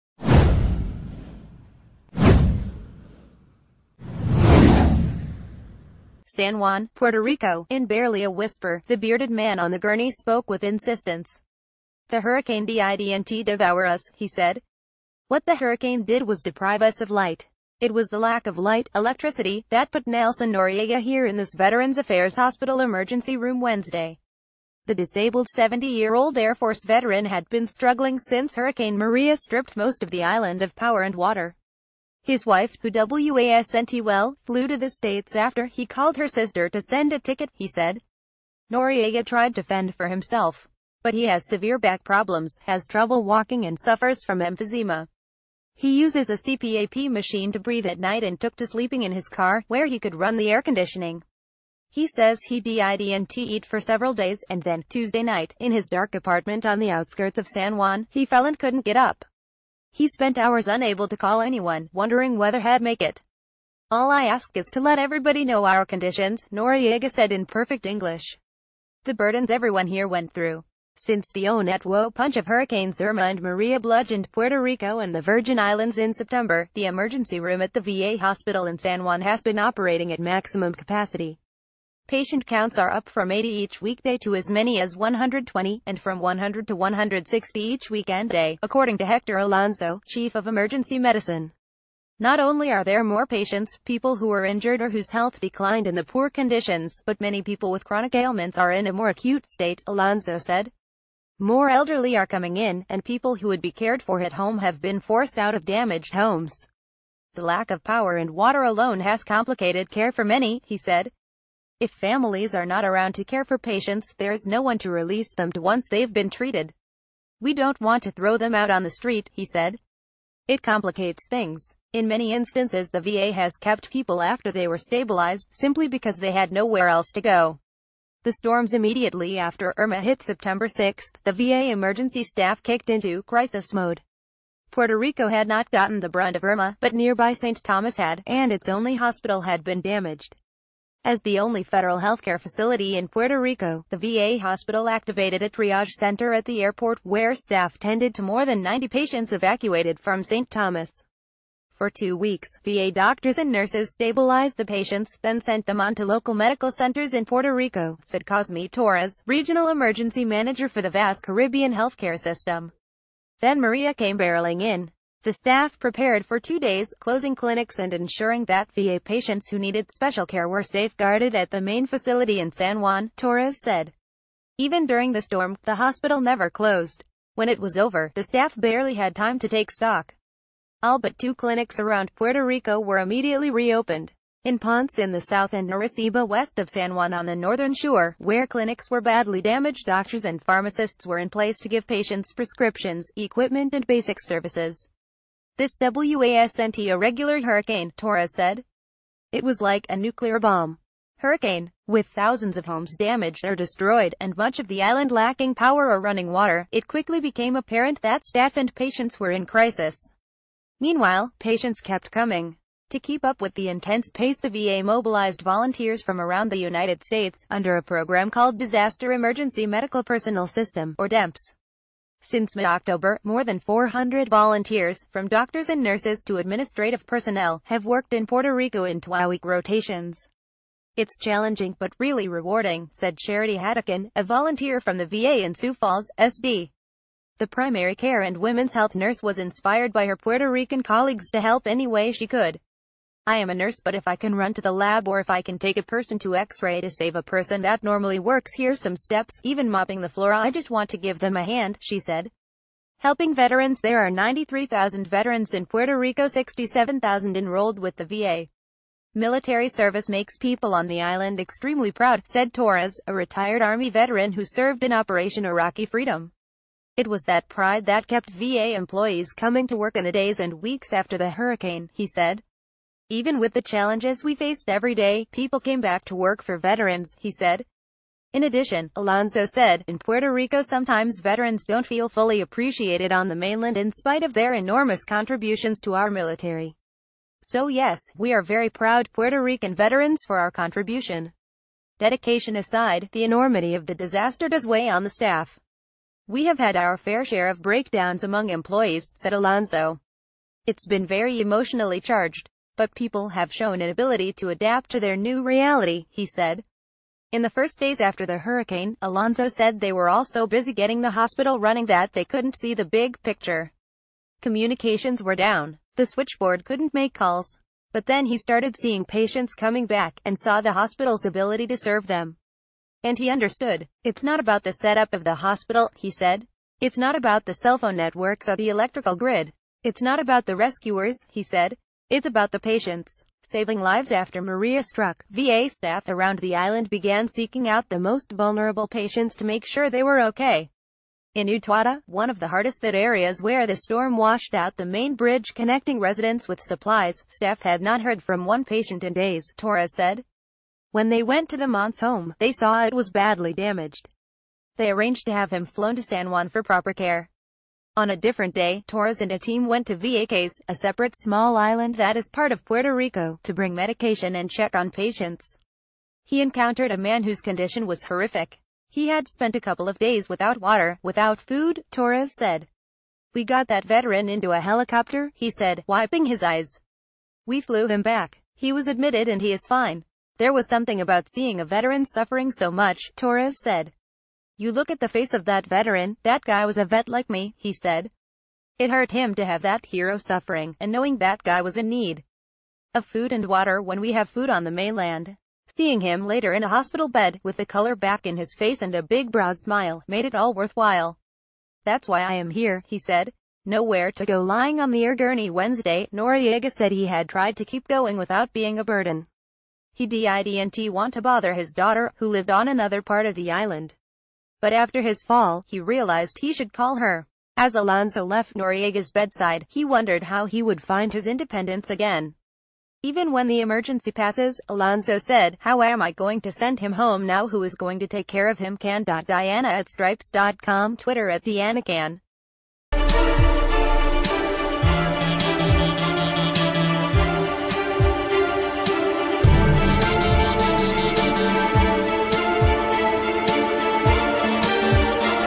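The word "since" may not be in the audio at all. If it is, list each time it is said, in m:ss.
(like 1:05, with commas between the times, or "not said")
0:28, 1:10, 3:42.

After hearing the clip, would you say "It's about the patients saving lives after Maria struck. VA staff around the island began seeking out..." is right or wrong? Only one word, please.
right.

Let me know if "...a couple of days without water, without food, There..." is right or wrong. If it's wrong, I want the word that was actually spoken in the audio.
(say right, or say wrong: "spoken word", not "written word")
wrong: "Torres", not "There".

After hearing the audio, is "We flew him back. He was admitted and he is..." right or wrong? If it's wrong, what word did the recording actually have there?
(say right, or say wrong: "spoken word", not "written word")
right.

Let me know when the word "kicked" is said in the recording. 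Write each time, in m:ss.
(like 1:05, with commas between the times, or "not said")
2:12.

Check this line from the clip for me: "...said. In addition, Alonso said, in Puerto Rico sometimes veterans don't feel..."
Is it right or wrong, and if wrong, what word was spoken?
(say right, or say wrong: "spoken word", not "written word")
right.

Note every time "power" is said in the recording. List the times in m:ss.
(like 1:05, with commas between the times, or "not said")
0:30, 1:47, 3:25.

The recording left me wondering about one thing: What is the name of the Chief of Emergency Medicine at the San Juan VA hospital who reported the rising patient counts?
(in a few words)
Hector Alonso.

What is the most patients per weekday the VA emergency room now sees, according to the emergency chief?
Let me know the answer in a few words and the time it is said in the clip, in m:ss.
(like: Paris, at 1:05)
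120, at 1:24.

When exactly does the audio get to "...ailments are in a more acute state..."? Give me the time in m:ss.
1:38.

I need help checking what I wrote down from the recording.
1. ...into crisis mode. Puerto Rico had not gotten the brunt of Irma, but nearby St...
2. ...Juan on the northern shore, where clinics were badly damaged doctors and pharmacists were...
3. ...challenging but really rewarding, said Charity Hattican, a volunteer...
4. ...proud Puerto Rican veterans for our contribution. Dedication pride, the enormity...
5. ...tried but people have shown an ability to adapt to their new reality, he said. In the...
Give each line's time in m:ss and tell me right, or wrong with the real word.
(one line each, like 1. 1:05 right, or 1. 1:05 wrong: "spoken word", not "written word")
1. 2:12 right
2. 3:06 right
3. 3:51 right
4. 4:48 wrong: "aside", not "pride"
5. 5:01 wrong: "charged", not "tried".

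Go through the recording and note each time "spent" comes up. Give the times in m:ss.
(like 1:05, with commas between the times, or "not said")
1:00, 6:09.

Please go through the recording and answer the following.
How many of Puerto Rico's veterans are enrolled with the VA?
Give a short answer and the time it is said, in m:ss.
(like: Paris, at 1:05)
67,000, at 4:16.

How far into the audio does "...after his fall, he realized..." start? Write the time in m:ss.
6:54.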